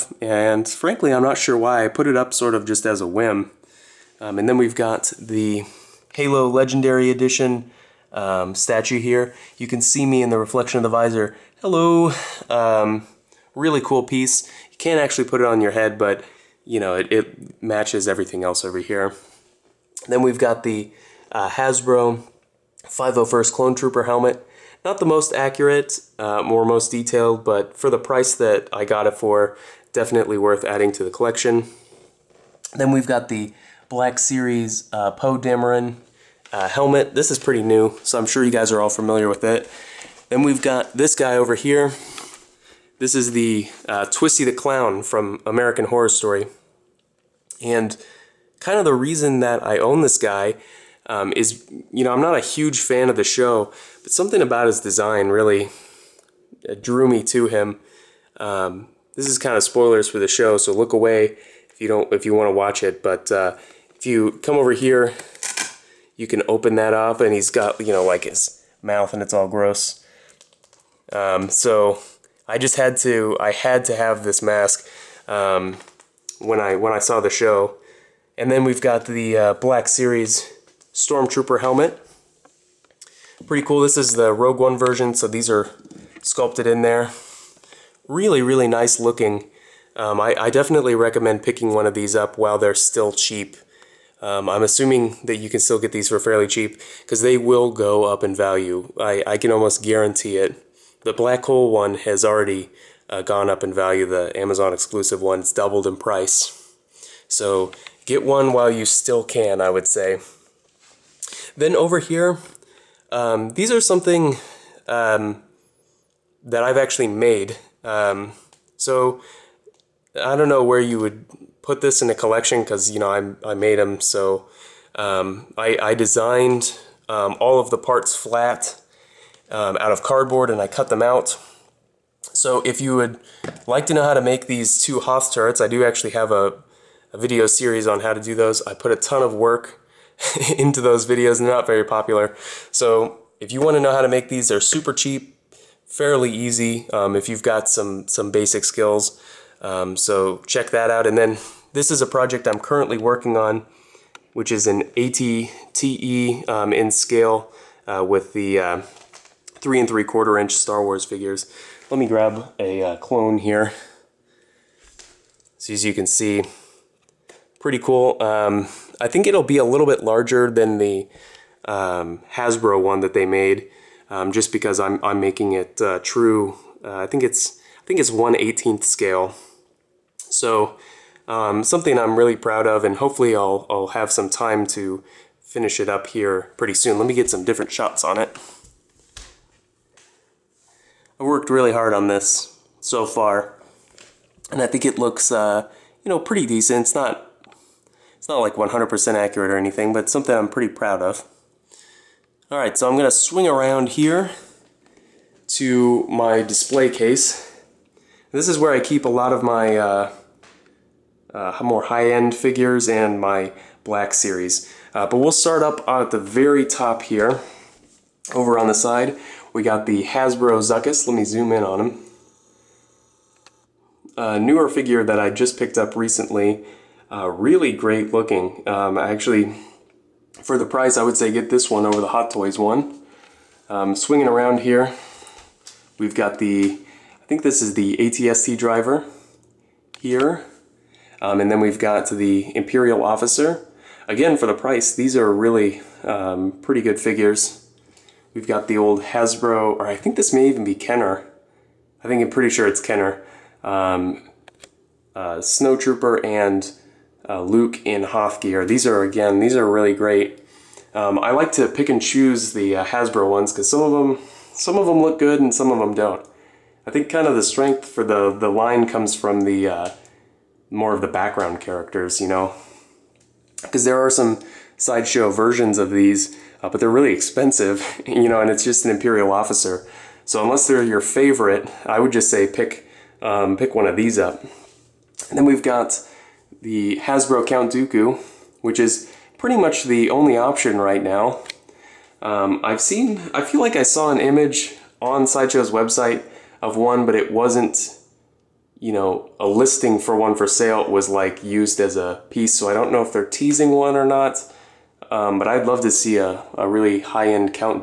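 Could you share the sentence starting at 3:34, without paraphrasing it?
Uh, but we'll start up at the very top here, over on the side, we got the Hasbro Zuckuss.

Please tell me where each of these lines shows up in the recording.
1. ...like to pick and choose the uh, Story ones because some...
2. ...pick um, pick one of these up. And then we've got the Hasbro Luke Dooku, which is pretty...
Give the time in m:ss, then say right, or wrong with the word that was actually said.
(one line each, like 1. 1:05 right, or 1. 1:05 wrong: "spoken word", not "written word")
1. 4:21 wrong: "Hasbro", not "Story"
2. 4:42 wrong: "Count", not "Luke".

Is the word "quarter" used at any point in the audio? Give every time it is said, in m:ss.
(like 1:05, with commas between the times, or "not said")
2:40.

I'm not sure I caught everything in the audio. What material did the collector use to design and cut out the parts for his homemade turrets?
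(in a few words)
cardboard.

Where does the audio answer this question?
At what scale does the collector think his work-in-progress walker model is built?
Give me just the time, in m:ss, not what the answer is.
2:58.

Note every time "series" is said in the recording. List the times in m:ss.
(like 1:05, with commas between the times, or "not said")
0:34, 1:19, 2:17, 3:34.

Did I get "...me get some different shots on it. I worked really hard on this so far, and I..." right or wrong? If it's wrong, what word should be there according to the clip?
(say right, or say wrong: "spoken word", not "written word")
right.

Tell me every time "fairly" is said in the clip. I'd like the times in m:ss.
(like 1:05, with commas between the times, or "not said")
1:36, 2:25.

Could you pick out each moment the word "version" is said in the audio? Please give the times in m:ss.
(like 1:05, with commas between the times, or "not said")
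1:24, 4:35.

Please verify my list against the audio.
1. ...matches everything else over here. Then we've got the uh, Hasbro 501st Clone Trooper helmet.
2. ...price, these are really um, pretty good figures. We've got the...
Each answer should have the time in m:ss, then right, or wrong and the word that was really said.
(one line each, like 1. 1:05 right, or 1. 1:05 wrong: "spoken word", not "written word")
1. 0:17 right
2. 4:04 right.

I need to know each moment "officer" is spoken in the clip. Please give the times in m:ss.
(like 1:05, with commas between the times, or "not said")
4:03, 4:39.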